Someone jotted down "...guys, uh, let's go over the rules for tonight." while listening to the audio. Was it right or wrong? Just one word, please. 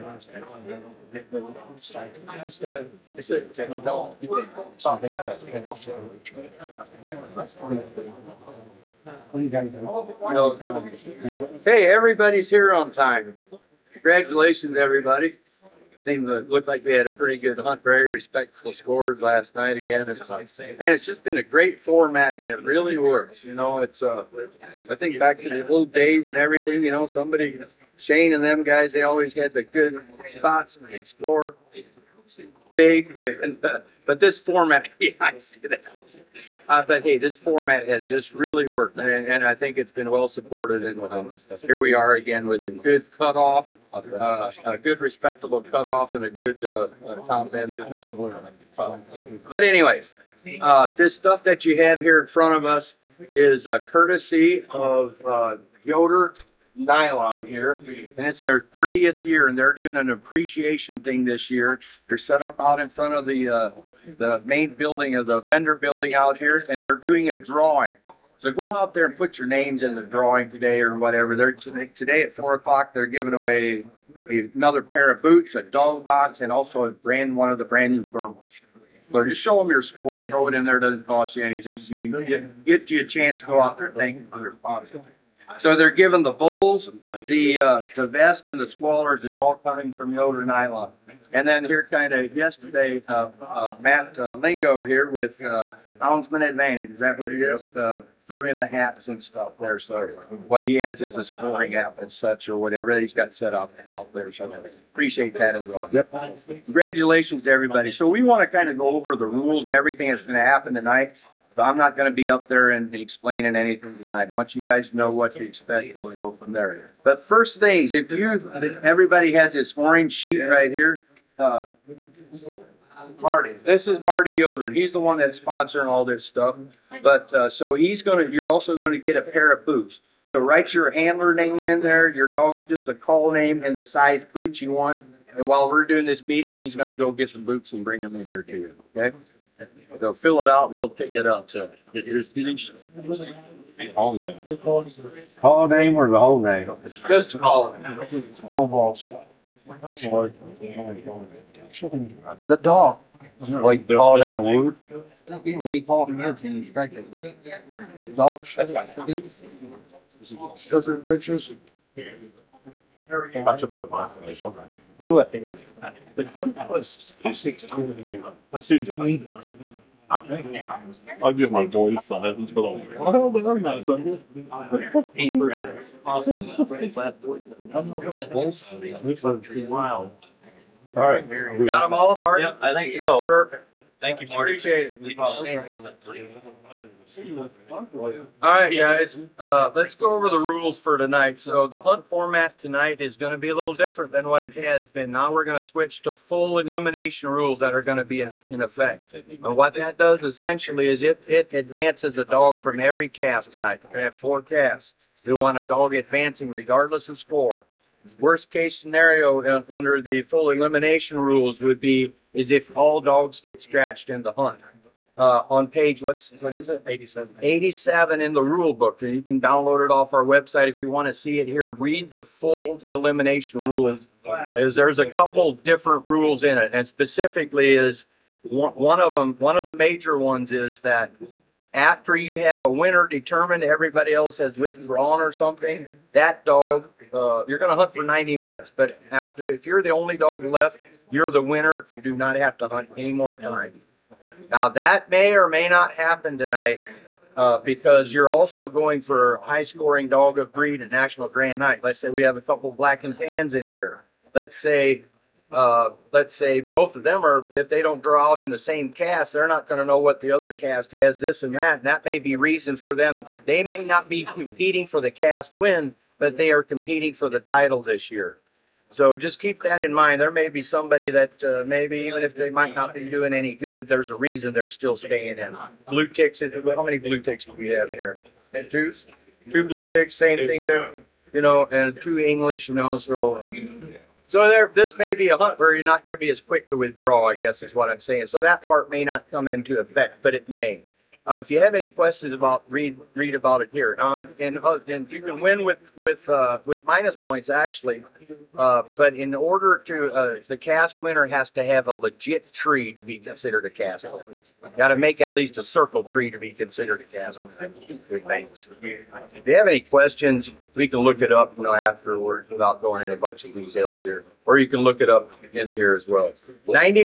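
right.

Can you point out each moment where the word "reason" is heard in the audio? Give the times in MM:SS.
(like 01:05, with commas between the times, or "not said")
04:22, 04:34.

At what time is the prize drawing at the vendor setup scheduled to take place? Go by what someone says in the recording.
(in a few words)
4 o'clock.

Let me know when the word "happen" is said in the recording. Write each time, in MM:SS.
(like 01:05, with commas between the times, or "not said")
01:50, 04:05.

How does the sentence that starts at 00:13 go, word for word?
Congratulations, everybody seemed to look like we had a pretty good hunt, very respectful scores last night again.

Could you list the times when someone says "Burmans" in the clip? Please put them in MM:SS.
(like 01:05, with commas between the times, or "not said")
01:18.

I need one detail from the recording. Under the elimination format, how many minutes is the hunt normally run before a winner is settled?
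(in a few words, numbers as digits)
90.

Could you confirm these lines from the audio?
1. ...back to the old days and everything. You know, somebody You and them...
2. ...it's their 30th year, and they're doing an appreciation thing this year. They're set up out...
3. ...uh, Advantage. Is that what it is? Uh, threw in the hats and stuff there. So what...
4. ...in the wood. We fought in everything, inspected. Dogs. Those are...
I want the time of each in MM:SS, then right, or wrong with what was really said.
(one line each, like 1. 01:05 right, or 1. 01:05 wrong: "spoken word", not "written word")
1. 00:25 wrong: "Shane", not "You"
2. 00:58 right
3. 01:36 right
4. 02:34 right.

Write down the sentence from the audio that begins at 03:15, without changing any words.
Now we're going to switch to full elimination rules that are going to be in, effect.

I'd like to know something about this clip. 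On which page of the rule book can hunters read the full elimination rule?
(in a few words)
87.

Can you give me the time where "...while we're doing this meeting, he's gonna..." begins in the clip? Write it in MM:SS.
02:15.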